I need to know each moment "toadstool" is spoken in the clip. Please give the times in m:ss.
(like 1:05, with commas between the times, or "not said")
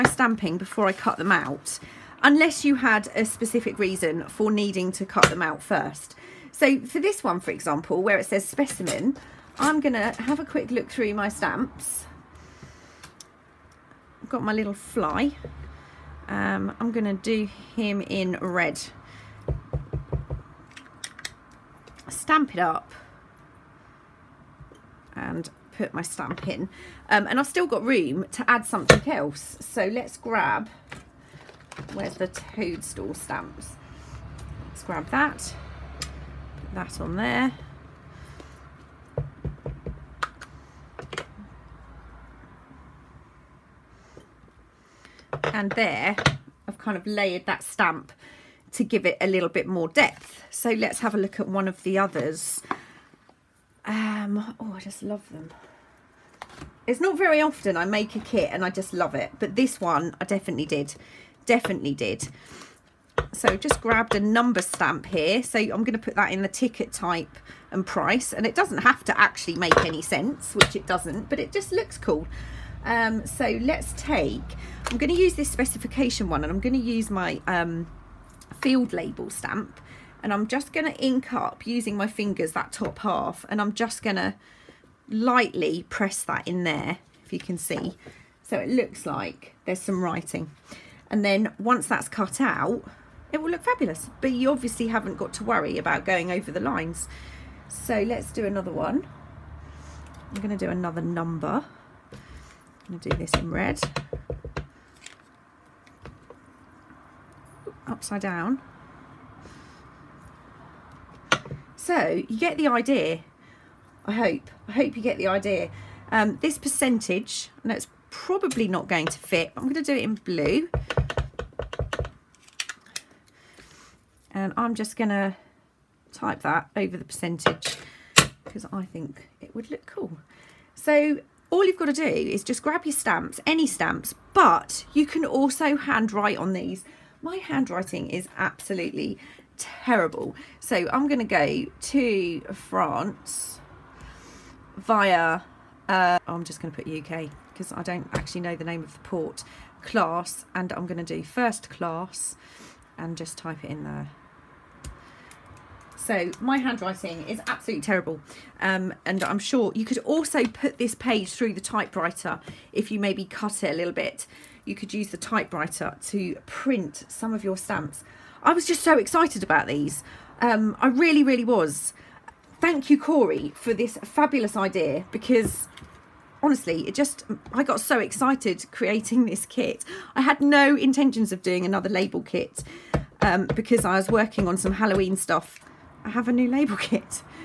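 0:32.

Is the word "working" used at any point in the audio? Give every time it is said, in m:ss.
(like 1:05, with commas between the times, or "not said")
3:04.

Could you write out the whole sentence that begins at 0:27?
Um, and I've still got room to add something else.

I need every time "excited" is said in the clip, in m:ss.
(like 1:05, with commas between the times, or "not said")
2:48, 2:57.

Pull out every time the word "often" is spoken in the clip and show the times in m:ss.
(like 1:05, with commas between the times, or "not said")
0:57.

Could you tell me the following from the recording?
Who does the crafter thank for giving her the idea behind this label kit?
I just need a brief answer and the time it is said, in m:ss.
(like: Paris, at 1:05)
Corey, at 2:52.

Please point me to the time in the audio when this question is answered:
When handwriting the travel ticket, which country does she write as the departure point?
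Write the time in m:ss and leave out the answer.
2:26.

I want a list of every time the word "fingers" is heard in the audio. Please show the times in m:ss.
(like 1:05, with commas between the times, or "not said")
1:22.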